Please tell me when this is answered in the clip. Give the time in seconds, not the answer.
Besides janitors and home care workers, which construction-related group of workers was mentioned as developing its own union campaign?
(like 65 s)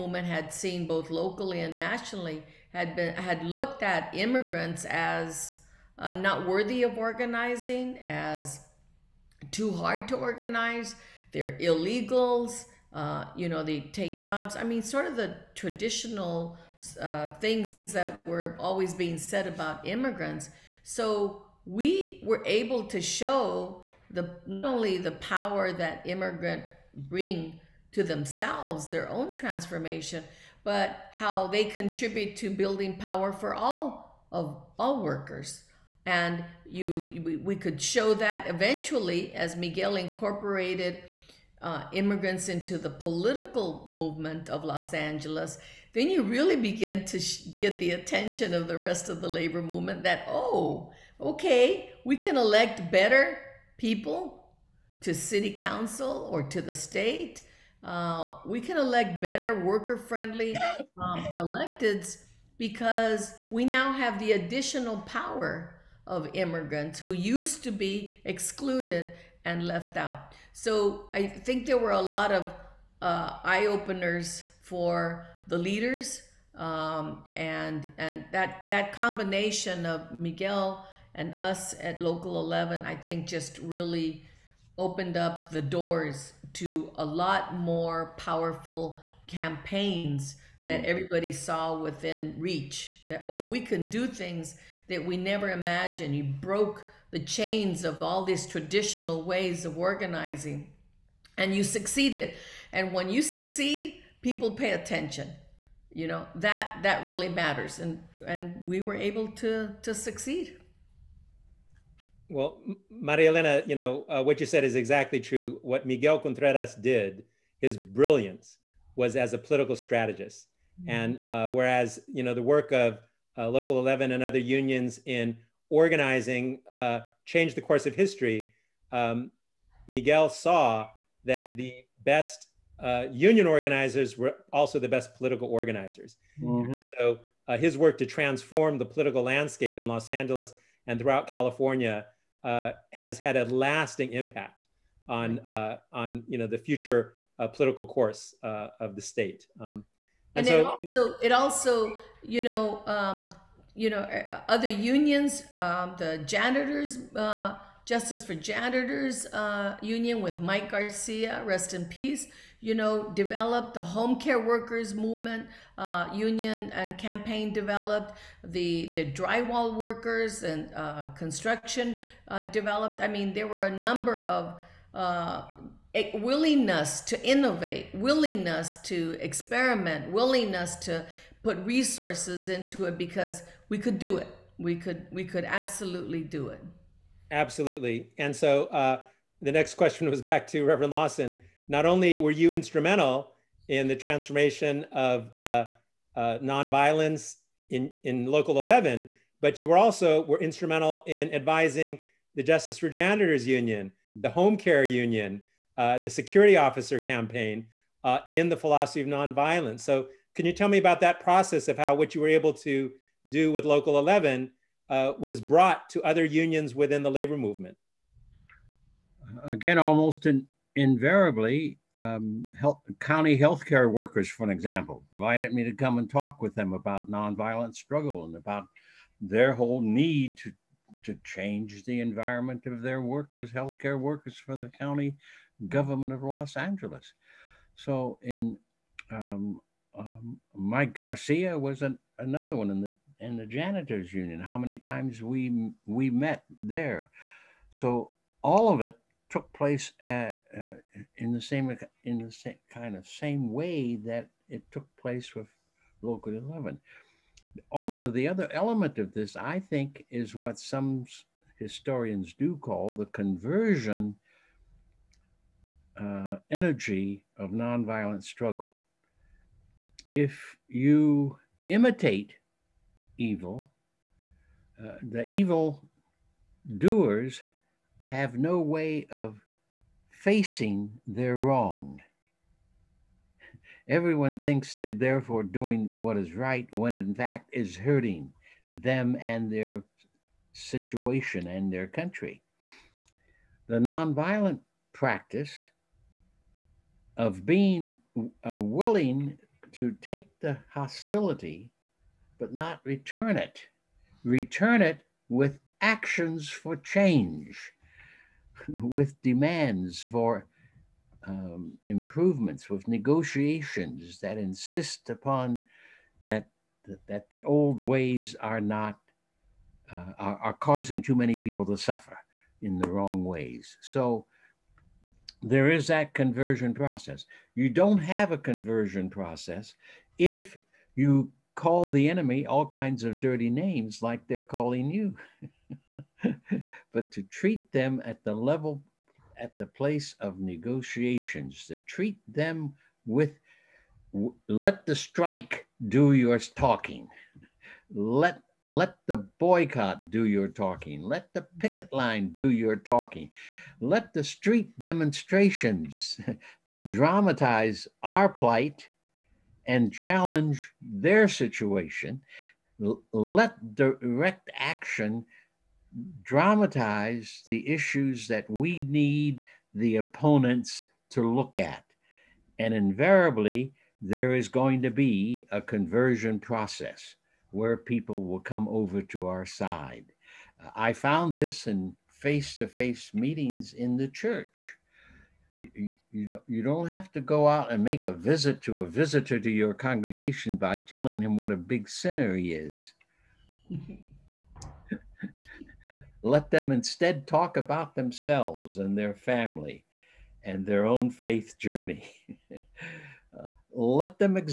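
169 s.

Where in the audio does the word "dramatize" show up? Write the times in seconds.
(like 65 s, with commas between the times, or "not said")
356 s, 366 s.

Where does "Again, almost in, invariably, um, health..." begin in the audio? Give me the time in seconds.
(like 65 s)
219 s.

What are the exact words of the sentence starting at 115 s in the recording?
What Miguel Contreras did, his brilliance was as a political strategist.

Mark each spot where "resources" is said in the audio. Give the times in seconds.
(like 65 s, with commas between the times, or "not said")
181 s.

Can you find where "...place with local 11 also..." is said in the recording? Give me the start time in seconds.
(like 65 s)
255 s.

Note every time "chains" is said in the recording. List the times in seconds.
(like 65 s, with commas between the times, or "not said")
97 s.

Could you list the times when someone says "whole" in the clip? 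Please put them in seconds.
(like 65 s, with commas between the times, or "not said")
229 s.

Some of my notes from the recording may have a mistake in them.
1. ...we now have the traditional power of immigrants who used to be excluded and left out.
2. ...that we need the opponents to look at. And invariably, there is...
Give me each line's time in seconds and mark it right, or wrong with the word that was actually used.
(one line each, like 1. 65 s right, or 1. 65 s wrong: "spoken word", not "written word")
1. 63 s wrong: "additional", not "traditional"
2. 368 s right.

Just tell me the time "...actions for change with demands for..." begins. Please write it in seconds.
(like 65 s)
305 s.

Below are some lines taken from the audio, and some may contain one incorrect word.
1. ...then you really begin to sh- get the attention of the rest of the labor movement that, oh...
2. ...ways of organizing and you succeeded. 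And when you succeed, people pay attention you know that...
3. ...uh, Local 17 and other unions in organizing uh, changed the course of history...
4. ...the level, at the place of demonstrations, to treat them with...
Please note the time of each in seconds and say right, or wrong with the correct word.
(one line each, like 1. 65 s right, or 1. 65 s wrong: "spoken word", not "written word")
1. 45 s right
2. 99 s right
3. 123 s wrong: "11", not "17"
4. 338 s wrong: "negotiations", not "demonstrations".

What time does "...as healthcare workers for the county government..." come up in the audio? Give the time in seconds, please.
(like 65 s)
233 s.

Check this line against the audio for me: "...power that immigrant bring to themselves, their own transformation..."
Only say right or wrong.
right.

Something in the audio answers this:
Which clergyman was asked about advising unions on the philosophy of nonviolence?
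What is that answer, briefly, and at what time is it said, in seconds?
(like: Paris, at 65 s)
Reverend Lawson, at 190 s.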